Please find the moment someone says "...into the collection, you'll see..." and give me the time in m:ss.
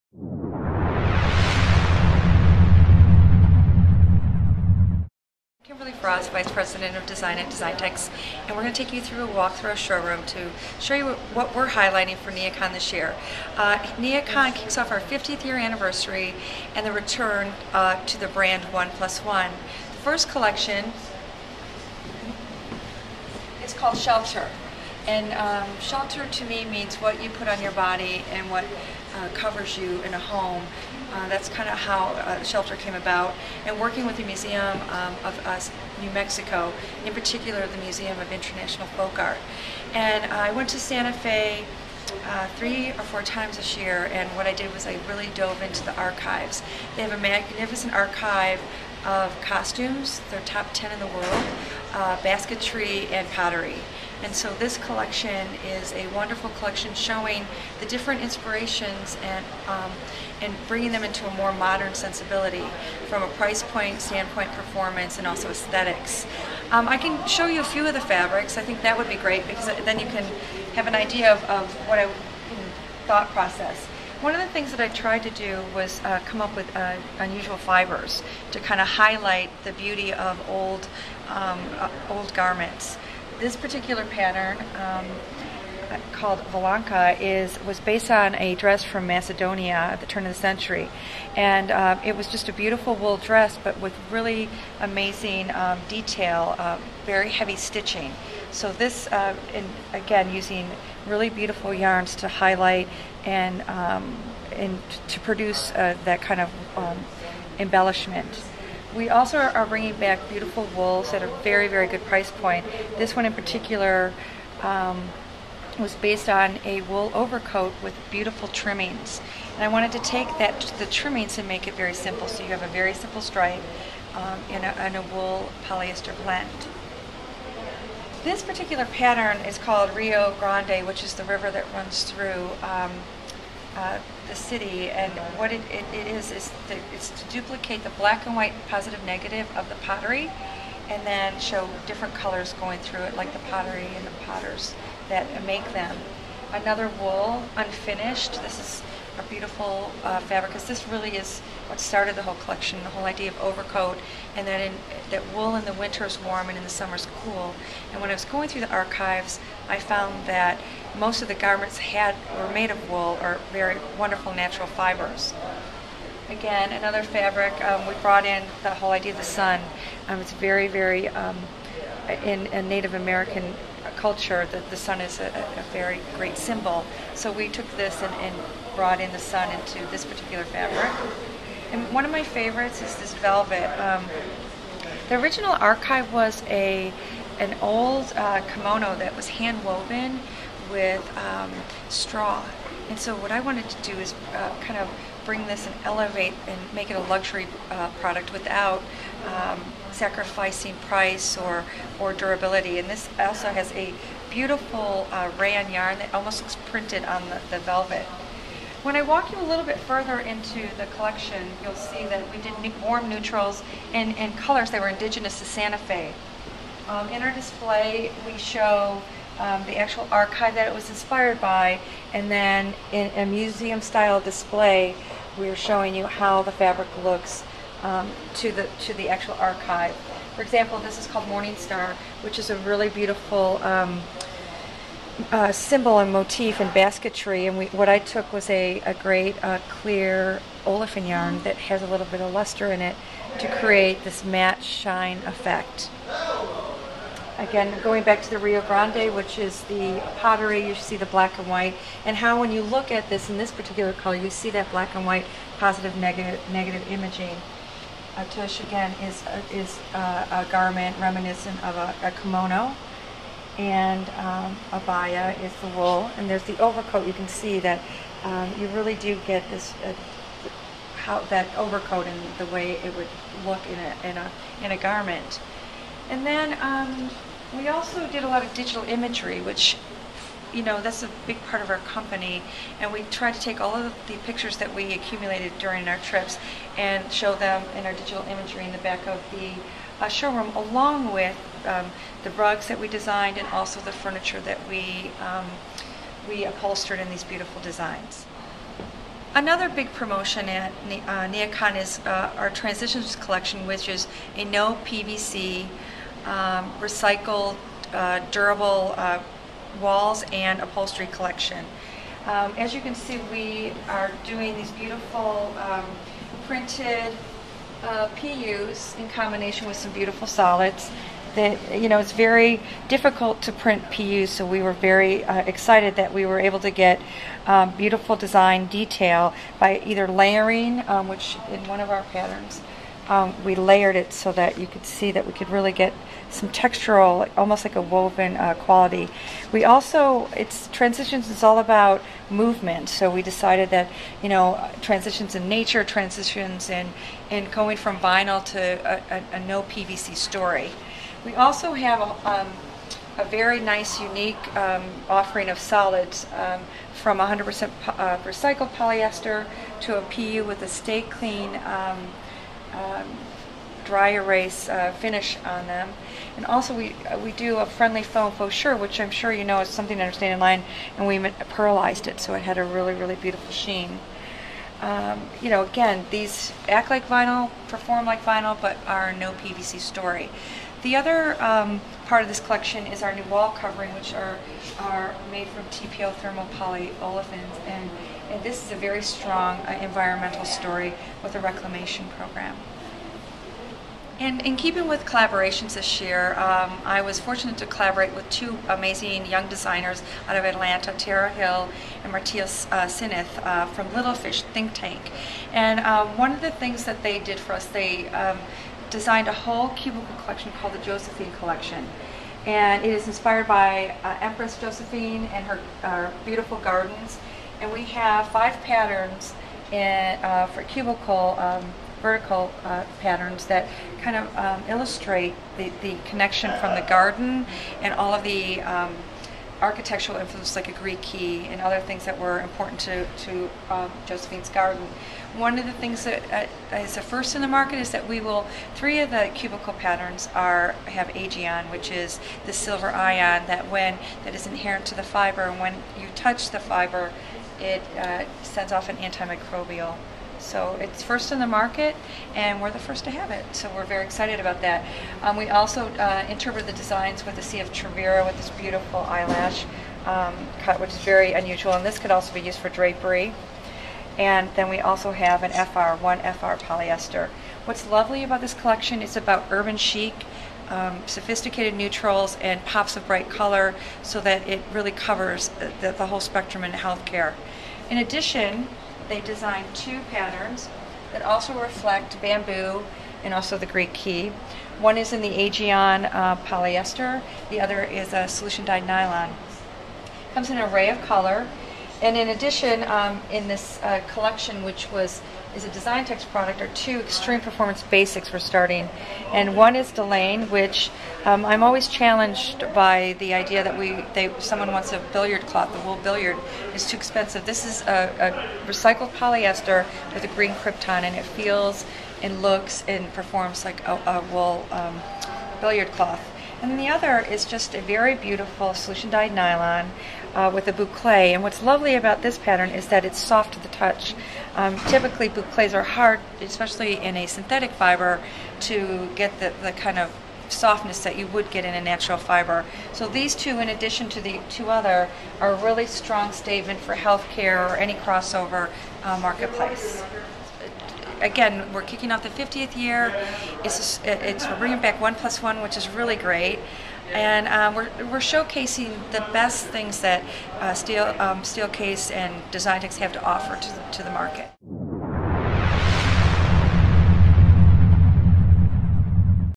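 3:30.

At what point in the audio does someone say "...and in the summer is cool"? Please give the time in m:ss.
2:36.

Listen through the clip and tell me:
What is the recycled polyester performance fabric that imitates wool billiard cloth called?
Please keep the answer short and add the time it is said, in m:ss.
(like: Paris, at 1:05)
Delane, at 8:19.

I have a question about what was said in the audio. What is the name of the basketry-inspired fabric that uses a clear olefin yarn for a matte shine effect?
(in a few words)
Morning Star.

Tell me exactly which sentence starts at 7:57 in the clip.
In addition, they designed two patterns that also reflect bamboo and also the Greek key.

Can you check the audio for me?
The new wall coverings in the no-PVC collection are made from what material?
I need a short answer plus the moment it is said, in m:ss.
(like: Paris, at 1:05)
TPO thermal polyolefins, at 6:25.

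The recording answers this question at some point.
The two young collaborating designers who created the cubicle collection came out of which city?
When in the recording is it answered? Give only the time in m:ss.
6:40.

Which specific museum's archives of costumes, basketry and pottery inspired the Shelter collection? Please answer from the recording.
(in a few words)
Museum of International Folk Art.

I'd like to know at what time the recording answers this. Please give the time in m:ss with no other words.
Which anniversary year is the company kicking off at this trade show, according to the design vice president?
0:14.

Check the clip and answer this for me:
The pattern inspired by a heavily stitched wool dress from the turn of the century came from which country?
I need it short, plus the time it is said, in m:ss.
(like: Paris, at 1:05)
Macedonia, at 1:29.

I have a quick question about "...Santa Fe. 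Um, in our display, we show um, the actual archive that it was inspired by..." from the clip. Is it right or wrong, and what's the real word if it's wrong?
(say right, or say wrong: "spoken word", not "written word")
right.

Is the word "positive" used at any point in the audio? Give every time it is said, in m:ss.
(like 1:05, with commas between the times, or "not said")
2:18, 4:15.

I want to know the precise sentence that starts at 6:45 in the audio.
And um, one of the things that they did for us, they um, designed a whole cubicle collection called the Josephine Collection.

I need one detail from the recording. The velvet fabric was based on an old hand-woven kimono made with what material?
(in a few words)
straw.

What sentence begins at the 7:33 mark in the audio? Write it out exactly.
So we're very excited about that.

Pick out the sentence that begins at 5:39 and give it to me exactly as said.
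We also, it's transitions is all about movement.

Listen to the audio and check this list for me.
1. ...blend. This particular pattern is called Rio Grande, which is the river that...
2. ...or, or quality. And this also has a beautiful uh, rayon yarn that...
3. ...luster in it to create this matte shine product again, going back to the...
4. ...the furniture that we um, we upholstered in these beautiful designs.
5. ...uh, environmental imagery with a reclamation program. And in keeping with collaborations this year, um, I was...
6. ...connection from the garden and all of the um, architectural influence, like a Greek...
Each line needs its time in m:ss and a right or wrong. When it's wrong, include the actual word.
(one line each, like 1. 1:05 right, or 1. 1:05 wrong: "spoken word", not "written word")
1. 2:06 right
2. 3:21 wrong: "durability", not "quality"
3. 4:02 wrong: "effect", not "product"
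4. 4:53 right
5. 6:29 wrong: "story", not "imagery"
6. 7:06 right.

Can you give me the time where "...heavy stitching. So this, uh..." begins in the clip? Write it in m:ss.
1:37.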